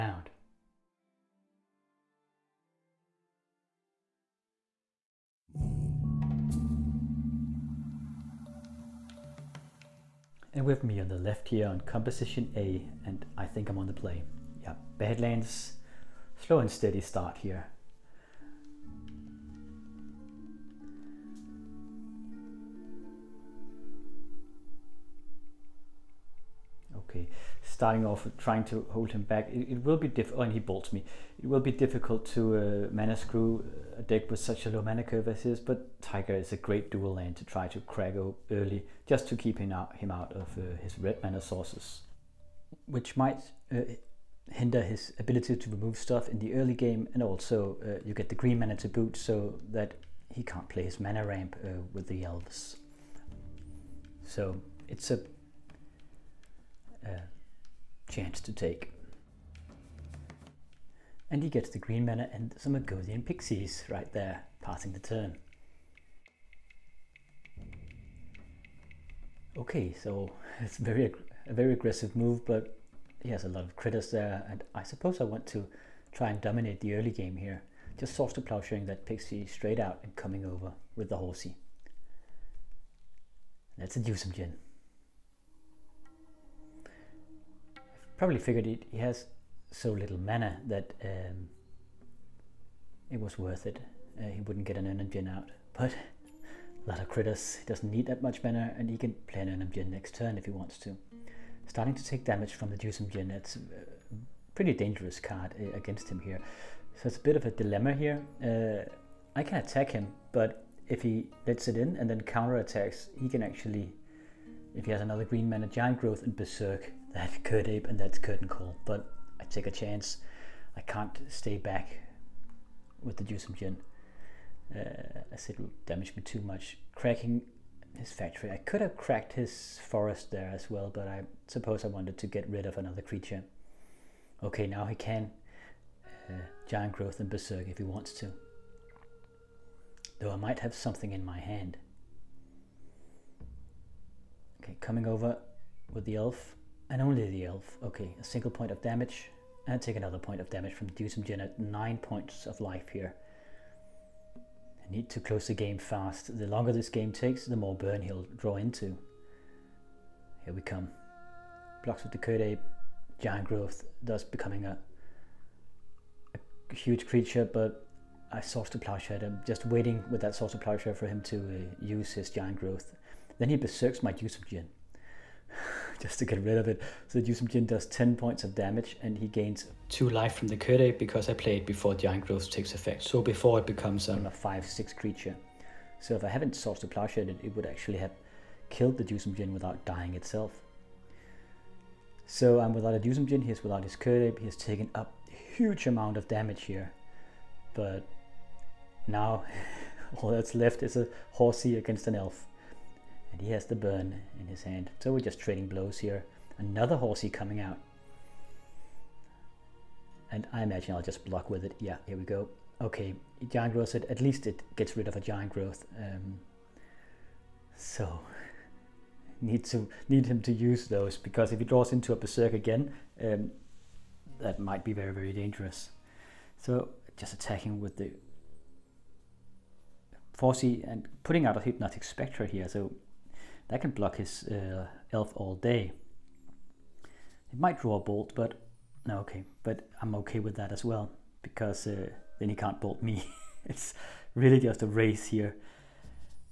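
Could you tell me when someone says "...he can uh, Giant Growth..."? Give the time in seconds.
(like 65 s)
134 s.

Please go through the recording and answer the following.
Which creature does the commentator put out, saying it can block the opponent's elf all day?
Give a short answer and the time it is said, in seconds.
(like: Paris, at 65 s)
Hypnotic Spectre, at 231 s.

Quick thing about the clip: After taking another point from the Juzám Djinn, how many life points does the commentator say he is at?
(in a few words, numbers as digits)
9.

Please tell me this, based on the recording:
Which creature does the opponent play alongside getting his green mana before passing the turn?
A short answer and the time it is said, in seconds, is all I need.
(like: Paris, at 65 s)
Argothian Pixies, at 62 s.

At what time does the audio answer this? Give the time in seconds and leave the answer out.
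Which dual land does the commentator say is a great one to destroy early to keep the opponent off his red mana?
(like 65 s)
35 s.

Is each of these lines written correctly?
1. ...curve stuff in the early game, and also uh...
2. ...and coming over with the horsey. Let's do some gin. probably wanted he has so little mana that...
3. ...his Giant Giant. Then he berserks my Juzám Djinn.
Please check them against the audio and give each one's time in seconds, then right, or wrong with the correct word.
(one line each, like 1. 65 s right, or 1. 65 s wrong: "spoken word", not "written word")
1. 45 s wrong: "remove", not "curve"
2. 80 s wrong: "figured", not "wanted"
3. 172 s wrong: "Growth", not "Giant".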